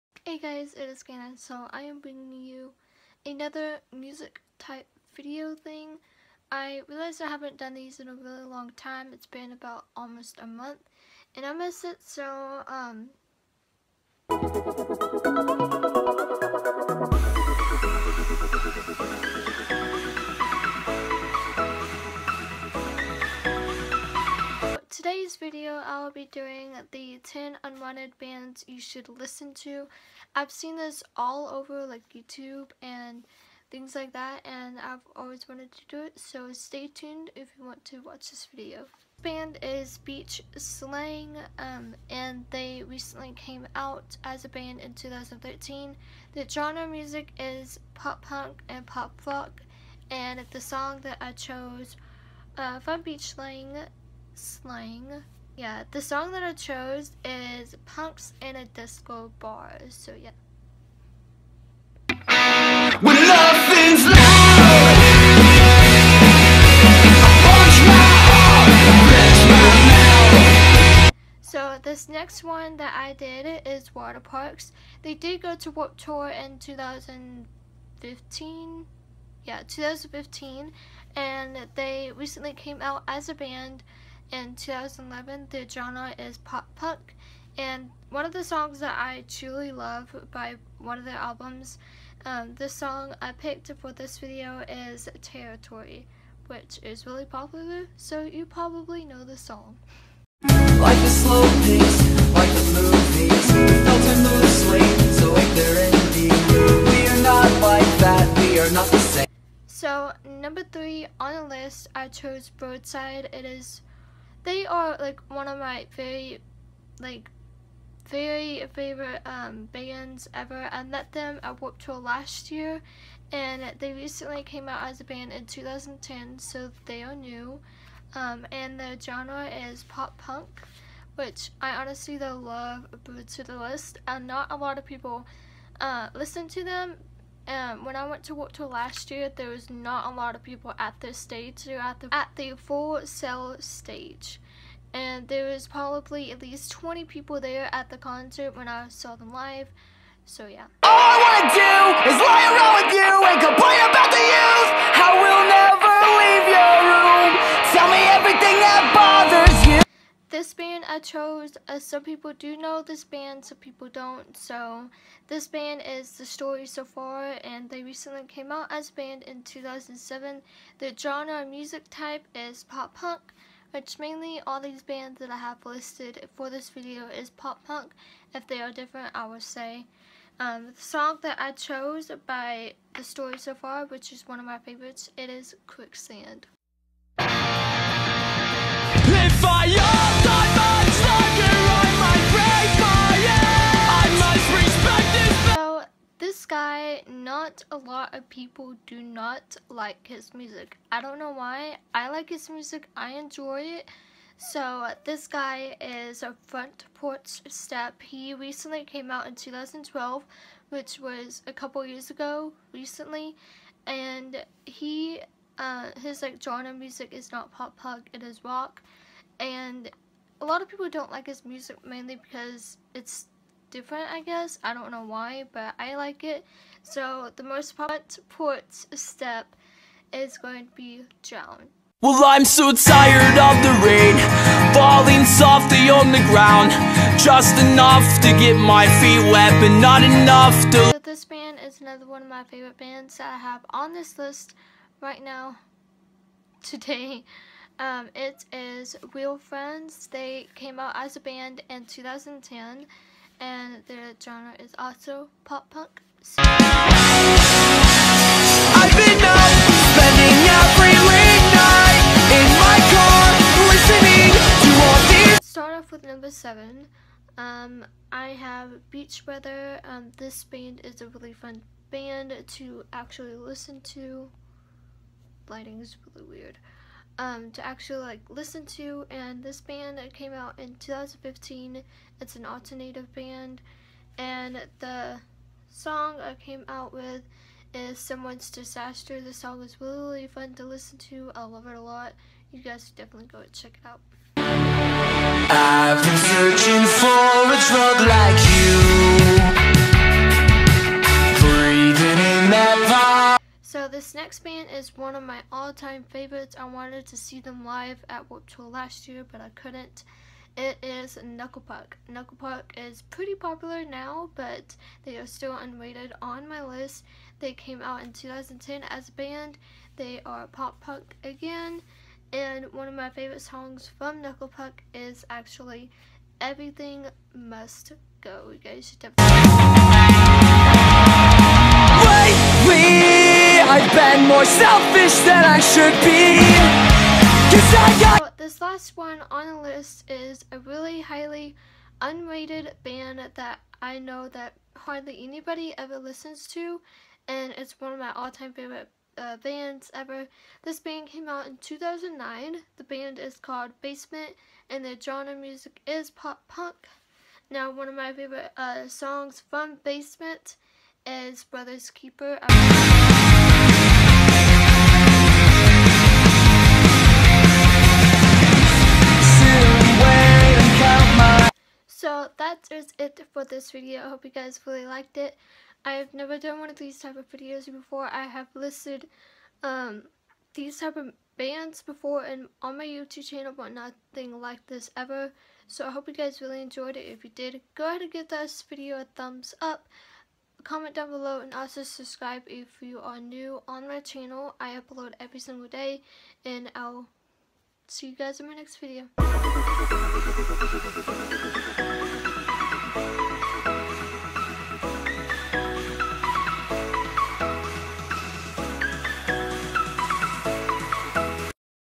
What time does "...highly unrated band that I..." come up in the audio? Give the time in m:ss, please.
5:40.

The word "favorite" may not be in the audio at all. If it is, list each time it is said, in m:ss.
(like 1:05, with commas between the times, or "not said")
1:58, 3:04, 4:02, 5:06, 5:23, 5:48, 5:58.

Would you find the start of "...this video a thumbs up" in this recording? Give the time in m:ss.
6:28.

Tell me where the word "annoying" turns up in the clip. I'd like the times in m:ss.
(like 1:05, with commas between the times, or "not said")
not said.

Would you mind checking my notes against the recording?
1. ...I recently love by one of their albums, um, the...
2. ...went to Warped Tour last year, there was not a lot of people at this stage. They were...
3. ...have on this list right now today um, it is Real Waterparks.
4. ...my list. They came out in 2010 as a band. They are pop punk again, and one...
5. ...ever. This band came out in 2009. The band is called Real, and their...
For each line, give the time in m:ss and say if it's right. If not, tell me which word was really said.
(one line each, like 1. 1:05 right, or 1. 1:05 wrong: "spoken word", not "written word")
1. 1:28 wrong: "truly", not "recently"
2. 2:18 right
3. 4:03 wrong: "Friends", not "Waterparks"
4. 5:16 right
5. 5:49 wrong: "Basement", not "Real".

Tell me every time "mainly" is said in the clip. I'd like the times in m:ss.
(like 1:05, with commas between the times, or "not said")
2:53, 3:41.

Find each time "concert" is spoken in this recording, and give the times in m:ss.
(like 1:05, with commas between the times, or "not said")
2:27.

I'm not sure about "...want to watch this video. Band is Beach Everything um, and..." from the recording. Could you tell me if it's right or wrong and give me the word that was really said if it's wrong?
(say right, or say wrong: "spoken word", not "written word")
wrong: "Slang", not "Everything".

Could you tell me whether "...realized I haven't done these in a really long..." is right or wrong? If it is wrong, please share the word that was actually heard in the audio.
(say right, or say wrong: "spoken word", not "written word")
right.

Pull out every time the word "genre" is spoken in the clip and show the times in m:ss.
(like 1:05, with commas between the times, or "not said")
0:46, 1:25, 2:09, 2:50, 3:36, 4:14, 5:54.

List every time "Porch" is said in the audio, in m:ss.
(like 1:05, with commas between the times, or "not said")
3:26.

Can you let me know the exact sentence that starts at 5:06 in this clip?
I wanted to see them live at Warped Tour last year, but I couldn't.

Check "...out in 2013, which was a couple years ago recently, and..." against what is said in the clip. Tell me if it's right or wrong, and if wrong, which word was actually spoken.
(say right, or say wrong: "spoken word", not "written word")
wrong: "2012", not "2013".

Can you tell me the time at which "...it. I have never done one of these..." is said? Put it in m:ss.
6:15.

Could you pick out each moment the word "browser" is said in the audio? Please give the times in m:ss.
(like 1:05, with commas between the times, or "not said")
not said.